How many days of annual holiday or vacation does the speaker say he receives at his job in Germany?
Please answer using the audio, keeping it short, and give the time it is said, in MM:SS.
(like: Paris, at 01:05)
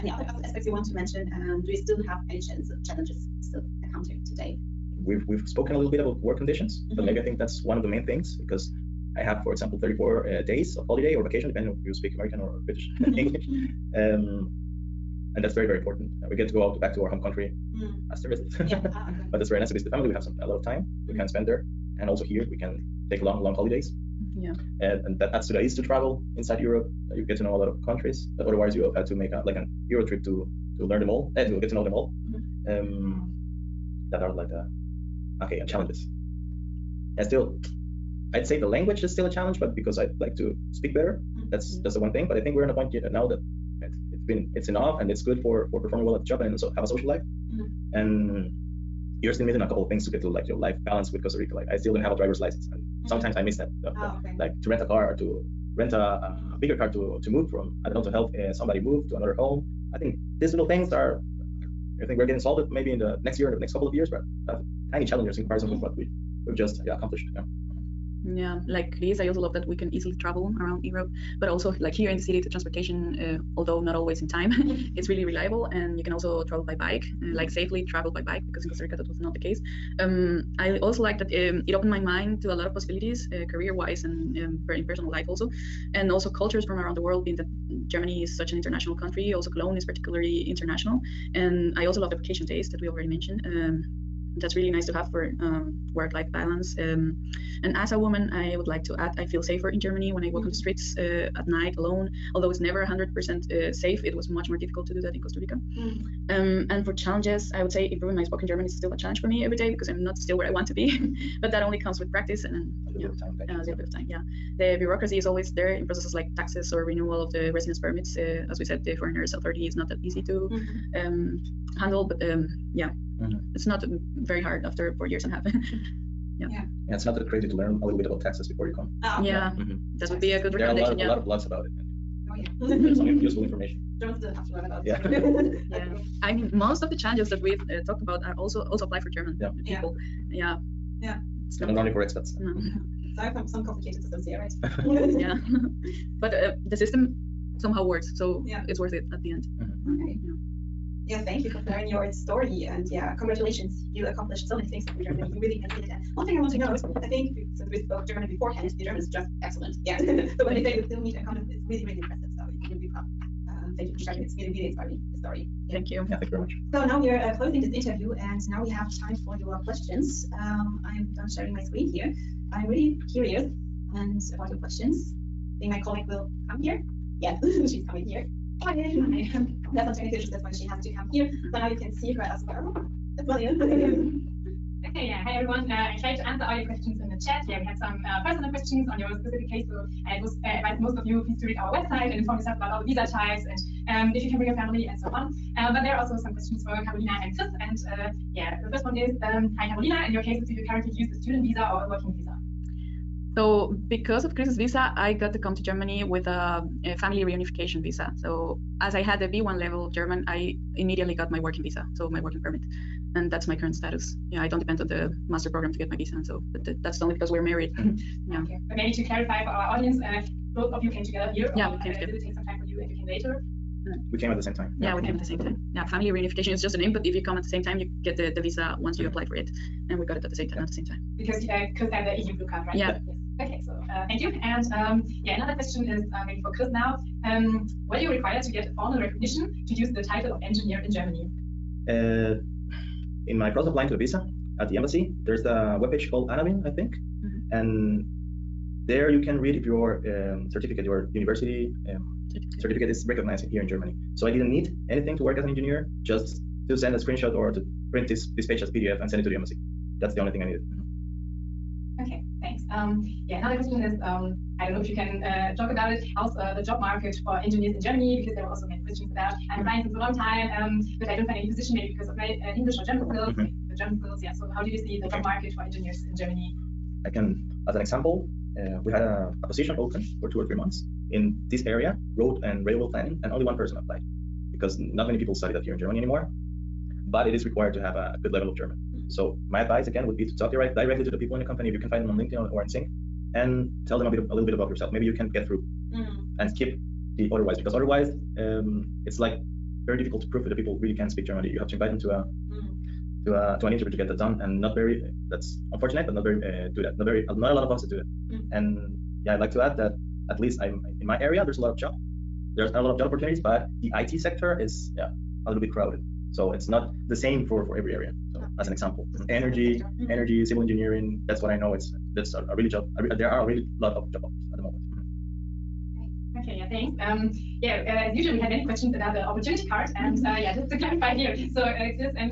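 34, at 00:09.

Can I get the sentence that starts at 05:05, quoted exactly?
That's unfortunate, but not very uh, do that.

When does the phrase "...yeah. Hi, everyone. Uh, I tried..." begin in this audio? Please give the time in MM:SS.
03:05.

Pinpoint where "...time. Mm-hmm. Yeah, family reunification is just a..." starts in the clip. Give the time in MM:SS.
03:45.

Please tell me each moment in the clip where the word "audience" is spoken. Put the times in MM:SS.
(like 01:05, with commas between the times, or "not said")
03:39.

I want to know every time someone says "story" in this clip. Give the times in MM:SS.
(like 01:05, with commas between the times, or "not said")
02:32, 02:45.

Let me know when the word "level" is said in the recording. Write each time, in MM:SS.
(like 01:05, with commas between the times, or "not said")
03:29, 04:48.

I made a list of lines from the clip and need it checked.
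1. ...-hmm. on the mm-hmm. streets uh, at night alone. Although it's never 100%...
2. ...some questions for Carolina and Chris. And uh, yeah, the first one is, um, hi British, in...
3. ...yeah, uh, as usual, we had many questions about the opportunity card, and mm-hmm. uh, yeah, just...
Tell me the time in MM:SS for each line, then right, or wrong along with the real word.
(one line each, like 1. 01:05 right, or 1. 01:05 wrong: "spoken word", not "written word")
1. 01:40 right
2. 03:16 wrong: "Carolina", not "British"
3. 05:27 right.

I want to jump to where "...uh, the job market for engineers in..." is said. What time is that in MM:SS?
04:26.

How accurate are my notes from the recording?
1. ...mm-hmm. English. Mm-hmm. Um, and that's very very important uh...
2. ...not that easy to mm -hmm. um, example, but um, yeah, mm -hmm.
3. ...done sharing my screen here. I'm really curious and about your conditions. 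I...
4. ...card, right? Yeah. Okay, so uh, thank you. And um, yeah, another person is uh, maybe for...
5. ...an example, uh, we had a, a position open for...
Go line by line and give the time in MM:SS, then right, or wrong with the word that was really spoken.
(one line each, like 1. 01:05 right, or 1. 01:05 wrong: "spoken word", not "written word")
1. 00:12 right
2. 01:59 wrong: "handle", not "example"
3. 02:51 wrong: "questions", not "conditions"
4. 03:52 wrong: "question", not "person"
5. 04:37 right.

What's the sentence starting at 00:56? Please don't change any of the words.
bigger car to to move from I don't know to help uh, somebody move to another home.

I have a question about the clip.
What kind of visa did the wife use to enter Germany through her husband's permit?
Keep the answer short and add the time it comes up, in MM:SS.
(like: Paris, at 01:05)
family reunification visa, at 03:26.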